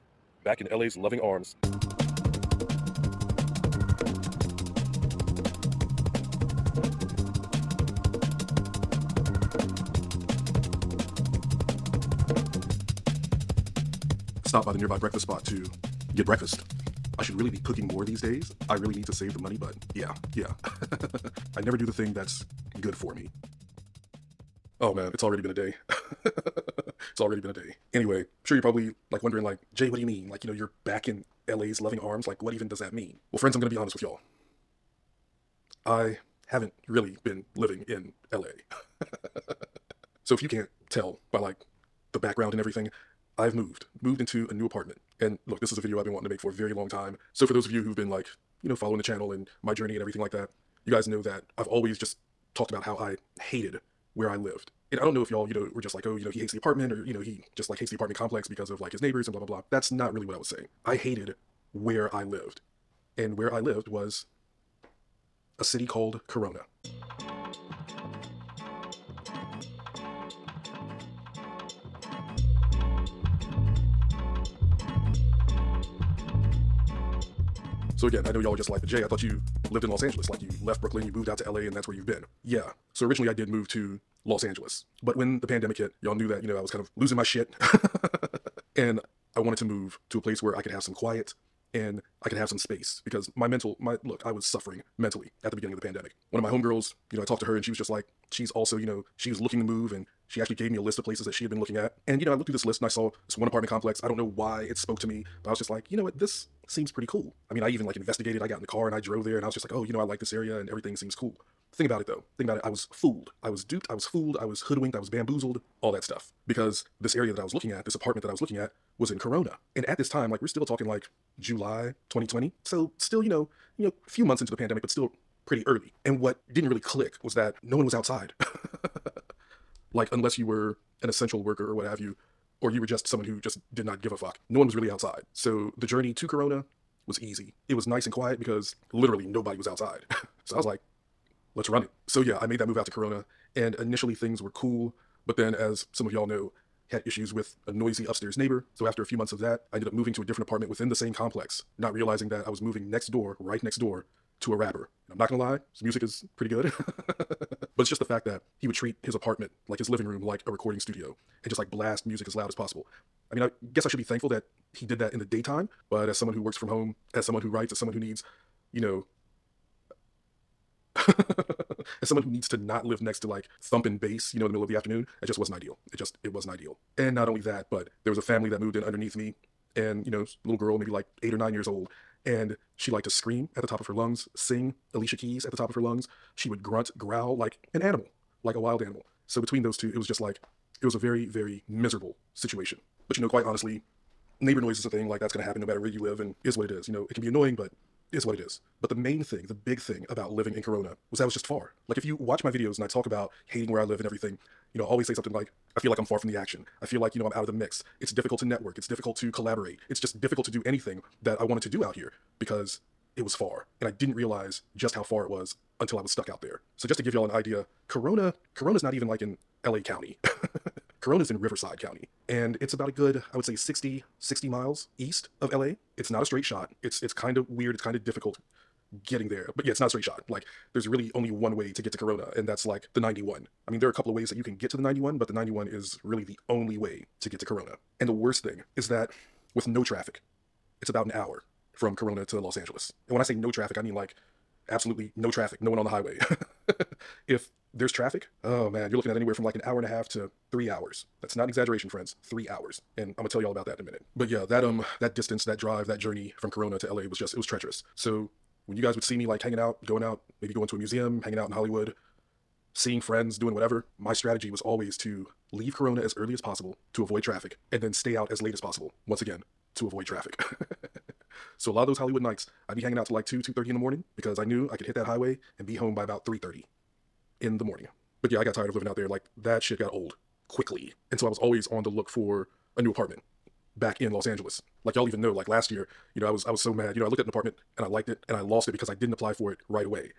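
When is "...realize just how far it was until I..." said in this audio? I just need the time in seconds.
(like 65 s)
214 s.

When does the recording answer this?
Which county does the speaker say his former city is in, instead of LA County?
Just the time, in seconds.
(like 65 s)
221 s.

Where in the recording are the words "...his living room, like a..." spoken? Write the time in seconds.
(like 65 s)
159 s.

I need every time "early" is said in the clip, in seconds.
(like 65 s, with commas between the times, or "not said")
125 s, 266 s.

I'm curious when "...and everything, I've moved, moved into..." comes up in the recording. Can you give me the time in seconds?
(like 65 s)
42 s.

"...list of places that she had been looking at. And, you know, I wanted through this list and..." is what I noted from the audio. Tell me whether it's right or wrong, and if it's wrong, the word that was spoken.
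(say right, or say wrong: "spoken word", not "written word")
wrong: "looked", not "wanted".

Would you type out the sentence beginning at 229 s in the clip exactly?
But yeah, it's not a straight shot.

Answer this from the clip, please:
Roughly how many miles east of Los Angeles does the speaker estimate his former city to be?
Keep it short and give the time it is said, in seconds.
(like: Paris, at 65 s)
60, at 224 s.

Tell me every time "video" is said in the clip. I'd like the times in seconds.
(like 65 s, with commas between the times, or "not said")
45 s, 202 s.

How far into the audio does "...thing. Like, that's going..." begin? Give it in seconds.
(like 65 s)
194 s.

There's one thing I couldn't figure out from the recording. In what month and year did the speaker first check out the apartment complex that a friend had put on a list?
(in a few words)
July 2020.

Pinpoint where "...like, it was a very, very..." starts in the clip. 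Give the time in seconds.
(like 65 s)
190 s.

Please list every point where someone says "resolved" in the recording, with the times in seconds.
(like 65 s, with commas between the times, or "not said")
not said.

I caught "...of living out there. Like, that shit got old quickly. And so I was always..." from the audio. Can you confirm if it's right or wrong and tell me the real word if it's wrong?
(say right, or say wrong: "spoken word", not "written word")
right.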